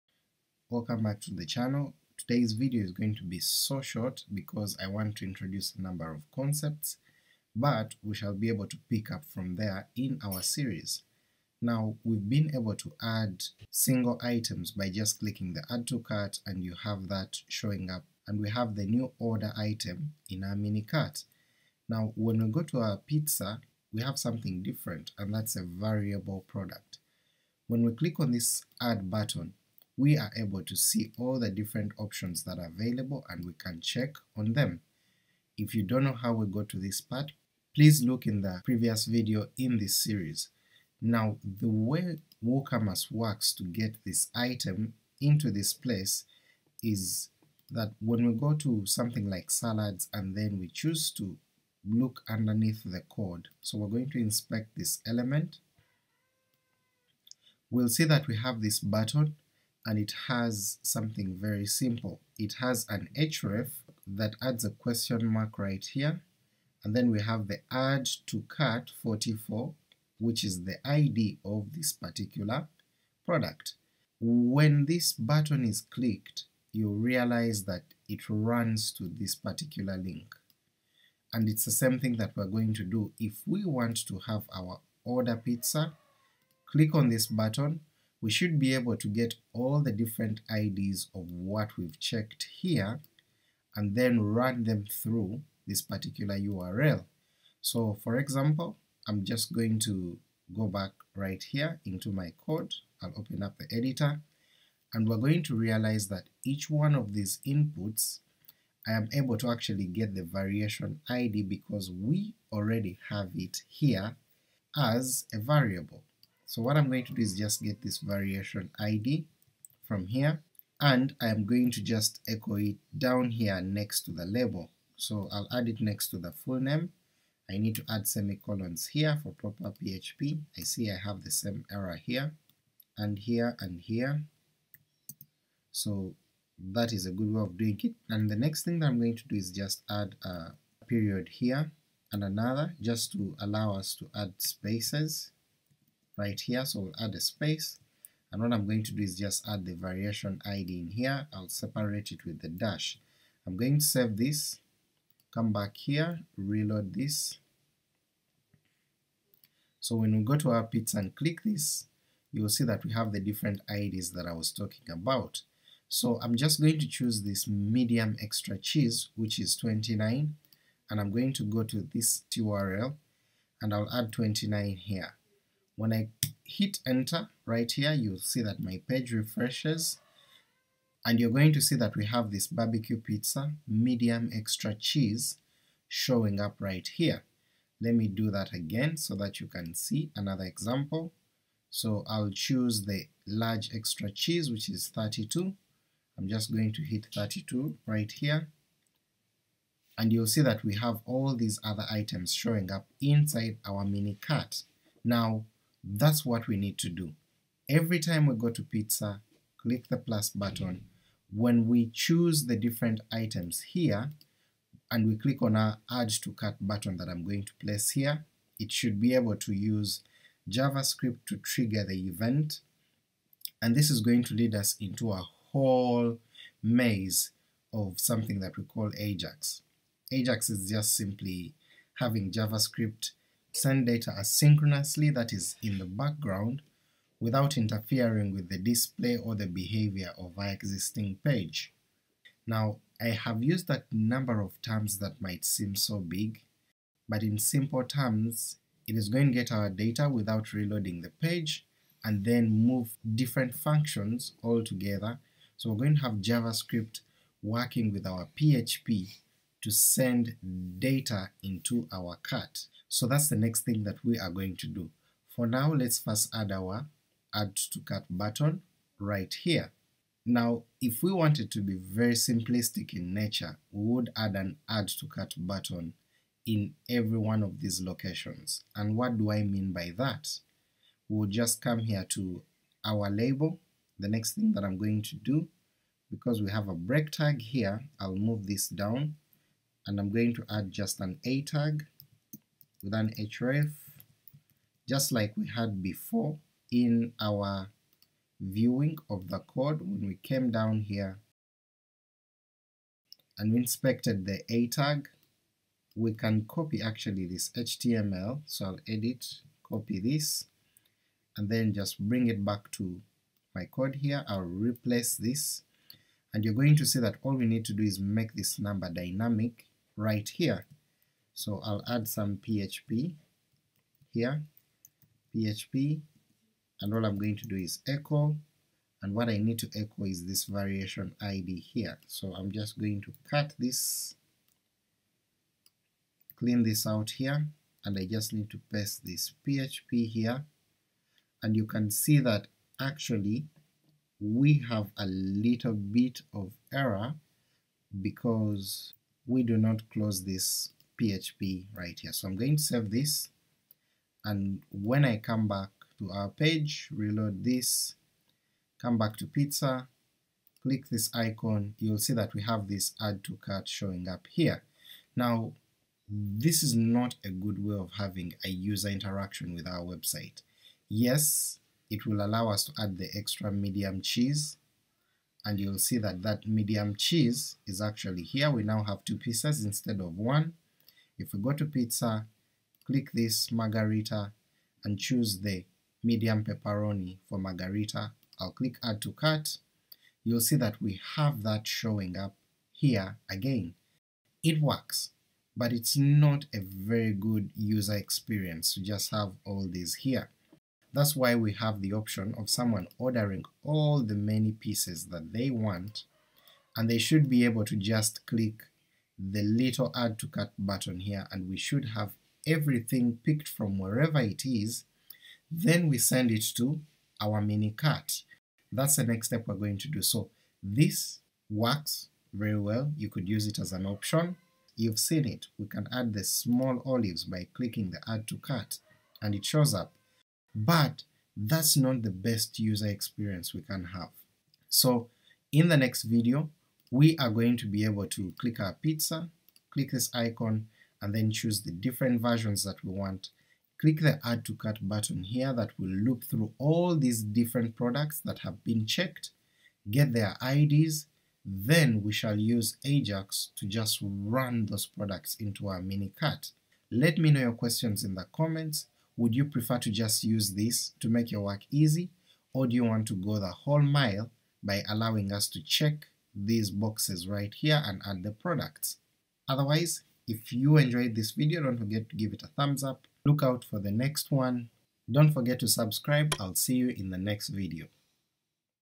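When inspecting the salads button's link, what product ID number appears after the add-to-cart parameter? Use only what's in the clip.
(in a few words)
44.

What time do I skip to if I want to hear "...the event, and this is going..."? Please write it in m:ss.
3:41.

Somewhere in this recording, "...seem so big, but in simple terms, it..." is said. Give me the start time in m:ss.
4:05.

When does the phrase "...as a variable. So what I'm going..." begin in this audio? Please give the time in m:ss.
1:54.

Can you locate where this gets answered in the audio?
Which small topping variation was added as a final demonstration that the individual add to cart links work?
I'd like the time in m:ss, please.
7:06.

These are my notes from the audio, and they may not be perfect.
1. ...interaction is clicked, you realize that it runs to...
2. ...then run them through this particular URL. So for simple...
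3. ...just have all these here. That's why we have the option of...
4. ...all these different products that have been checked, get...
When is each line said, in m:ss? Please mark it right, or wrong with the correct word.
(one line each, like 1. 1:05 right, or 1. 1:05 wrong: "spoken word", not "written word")
1. 1:15 wrong: "button", not "interaction"
2. 1:33 wrong: "example", not "simple"
3. 6:38 right
4. 7:26 right.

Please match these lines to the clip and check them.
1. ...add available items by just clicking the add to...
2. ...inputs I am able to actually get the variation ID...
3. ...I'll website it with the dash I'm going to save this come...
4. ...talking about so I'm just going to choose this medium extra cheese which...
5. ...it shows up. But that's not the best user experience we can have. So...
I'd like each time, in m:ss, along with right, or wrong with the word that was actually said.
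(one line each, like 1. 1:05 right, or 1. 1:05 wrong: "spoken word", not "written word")
1. 0:13 wrong: "single", not "available"
2. 1:47 right
3. 2:31 wrong: "separate", not "website"
4. 2:44 right
5. 7:09 right.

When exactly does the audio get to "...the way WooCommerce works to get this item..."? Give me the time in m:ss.
0:41.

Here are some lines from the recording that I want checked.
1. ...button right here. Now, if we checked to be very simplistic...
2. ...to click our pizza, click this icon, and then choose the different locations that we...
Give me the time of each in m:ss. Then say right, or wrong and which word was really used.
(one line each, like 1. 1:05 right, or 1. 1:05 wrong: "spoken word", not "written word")
1. 4:28 wrong: "wanted", not "checked"
2. 7:18 wrong: "versions", not "locations".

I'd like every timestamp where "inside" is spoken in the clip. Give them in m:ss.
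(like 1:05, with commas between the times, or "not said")
3:23.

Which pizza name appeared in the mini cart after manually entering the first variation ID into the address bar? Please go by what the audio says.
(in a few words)
Barbecue pizza.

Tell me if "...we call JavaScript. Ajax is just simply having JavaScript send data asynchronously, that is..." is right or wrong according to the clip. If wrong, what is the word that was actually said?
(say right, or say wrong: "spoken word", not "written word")
wrong: "Ajax", not "JavaScript".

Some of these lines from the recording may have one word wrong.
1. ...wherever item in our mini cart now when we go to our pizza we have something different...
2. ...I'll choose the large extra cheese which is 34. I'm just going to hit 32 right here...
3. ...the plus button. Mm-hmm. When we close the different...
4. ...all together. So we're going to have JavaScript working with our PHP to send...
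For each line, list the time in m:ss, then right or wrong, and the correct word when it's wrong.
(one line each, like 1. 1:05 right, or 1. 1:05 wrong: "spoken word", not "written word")
1. 0:19 wrong: "order", not "wherever"
2. 3:12 wrong: "32", not "34"
3. 3:29 wrong: "choose", not "close"
4. 4:14 right.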